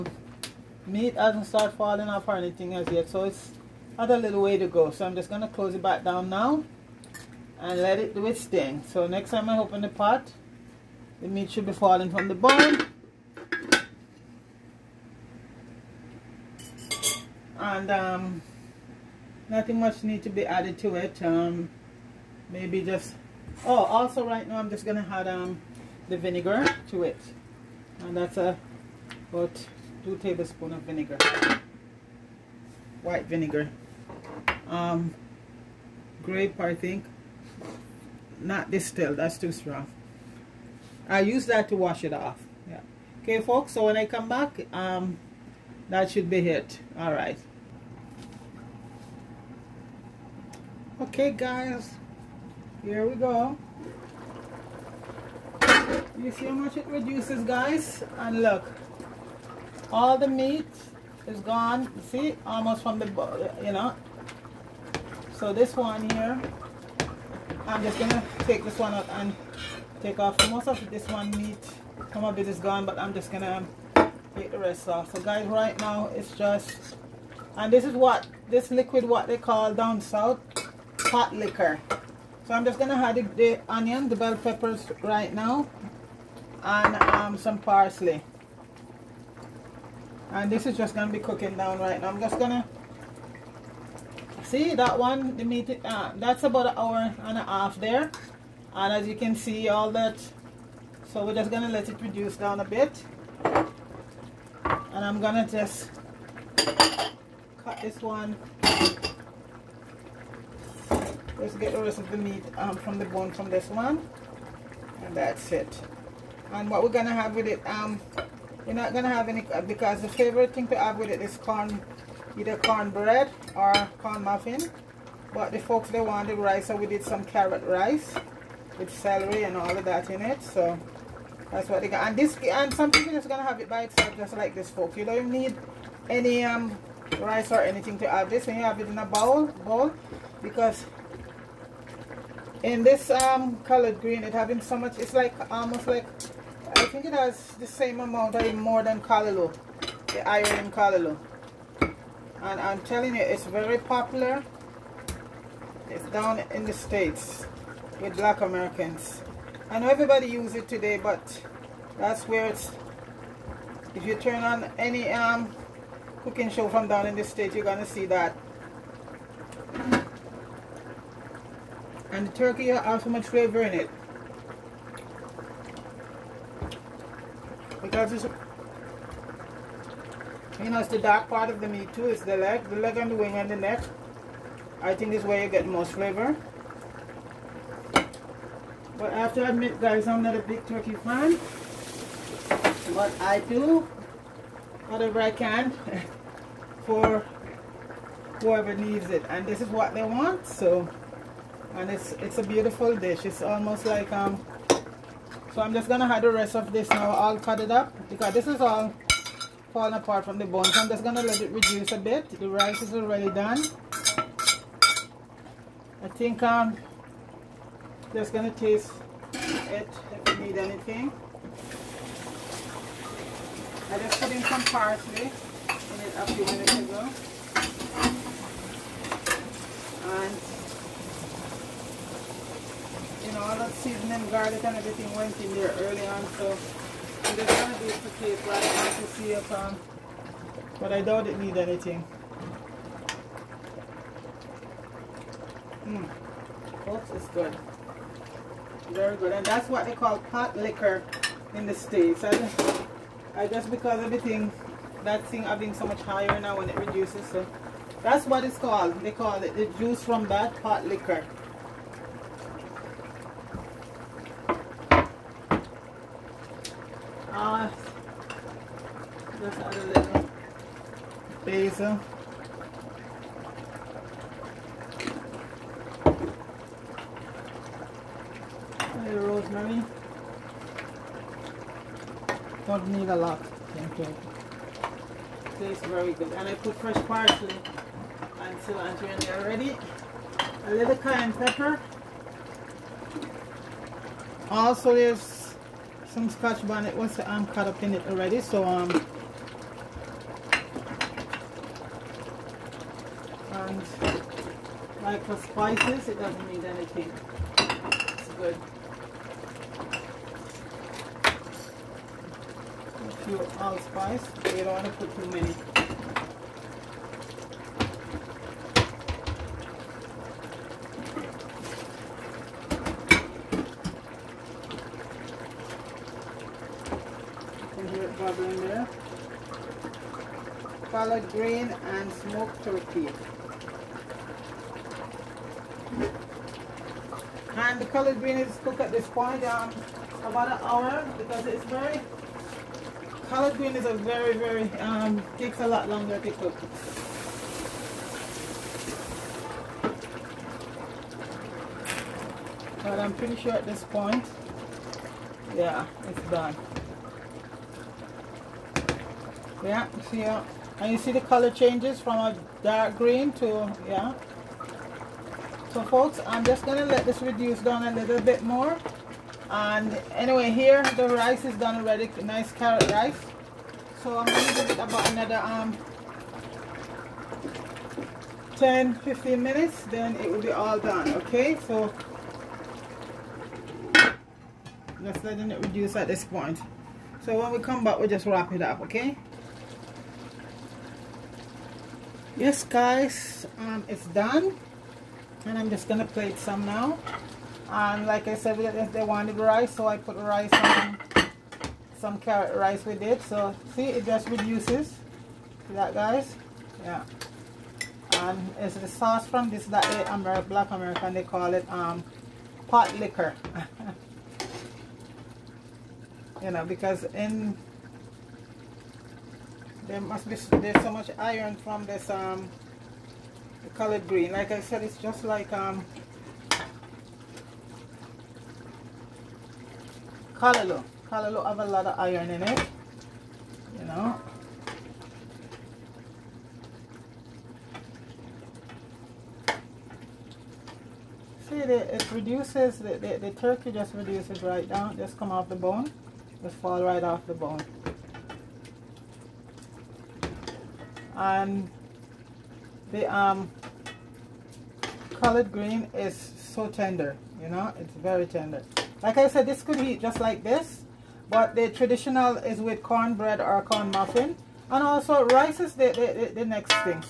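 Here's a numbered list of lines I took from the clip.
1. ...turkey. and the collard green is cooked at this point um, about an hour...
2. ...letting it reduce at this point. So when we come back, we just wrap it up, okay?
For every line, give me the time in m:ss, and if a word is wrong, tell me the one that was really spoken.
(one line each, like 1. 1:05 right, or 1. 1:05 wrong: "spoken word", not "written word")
1. 5:32 right
2. 6:25 right.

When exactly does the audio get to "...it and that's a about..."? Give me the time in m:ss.
0:27.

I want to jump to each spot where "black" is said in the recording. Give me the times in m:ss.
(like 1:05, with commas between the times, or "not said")
2:38, 6:50.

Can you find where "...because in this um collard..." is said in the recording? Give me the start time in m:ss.
2:20.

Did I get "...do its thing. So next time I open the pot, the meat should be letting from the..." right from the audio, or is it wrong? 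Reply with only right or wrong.
wrong.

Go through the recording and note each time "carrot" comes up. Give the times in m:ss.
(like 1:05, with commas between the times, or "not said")
2:07, 6:12, 6:42.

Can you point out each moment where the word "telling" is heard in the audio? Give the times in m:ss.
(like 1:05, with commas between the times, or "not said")
2:32.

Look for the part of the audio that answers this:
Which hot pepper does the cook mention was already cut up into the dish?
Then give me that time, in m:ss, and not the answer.
4:56.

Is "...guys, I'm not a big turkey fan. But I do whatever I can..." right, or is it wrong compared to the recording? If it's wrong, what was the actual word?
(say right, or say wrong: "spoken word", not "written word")
right.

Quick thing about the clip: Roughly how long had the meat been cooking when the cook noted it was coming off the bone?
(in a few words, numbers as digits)
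an hour and a half.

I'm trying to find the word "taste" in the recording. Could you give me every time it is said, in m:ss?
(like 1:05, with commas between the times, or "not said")
3:38, 4:45.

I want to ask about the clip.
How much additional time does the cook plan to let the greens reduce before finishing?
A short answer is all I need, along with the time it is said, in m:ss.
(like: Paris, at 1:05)
10 to 15 minutes, at 6:18.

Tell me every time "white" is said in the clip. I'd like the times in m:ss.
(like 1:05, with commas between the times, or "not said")
0:33.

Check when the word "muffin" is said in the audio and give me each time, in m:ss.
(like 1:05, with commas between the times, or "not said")
2:04, 7:43.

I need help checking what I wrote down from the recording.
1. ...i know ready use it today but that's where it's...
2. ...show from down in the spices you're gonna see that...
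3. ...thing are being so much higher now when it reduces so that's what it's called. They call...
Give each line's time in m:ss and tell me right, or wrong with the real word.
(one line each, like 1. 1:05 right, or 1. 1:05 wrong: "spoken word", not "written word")
1. 2:39 wrong: "everybody", not "ready"
2. 2:46 wrong: "states", not "spices"
3. 4:15 right.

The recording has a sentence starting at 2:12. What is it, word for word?
And this, and some people just going to have it by itself, just like this, folks.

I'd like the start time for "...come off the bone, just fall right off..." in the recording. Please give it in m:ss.
7:25.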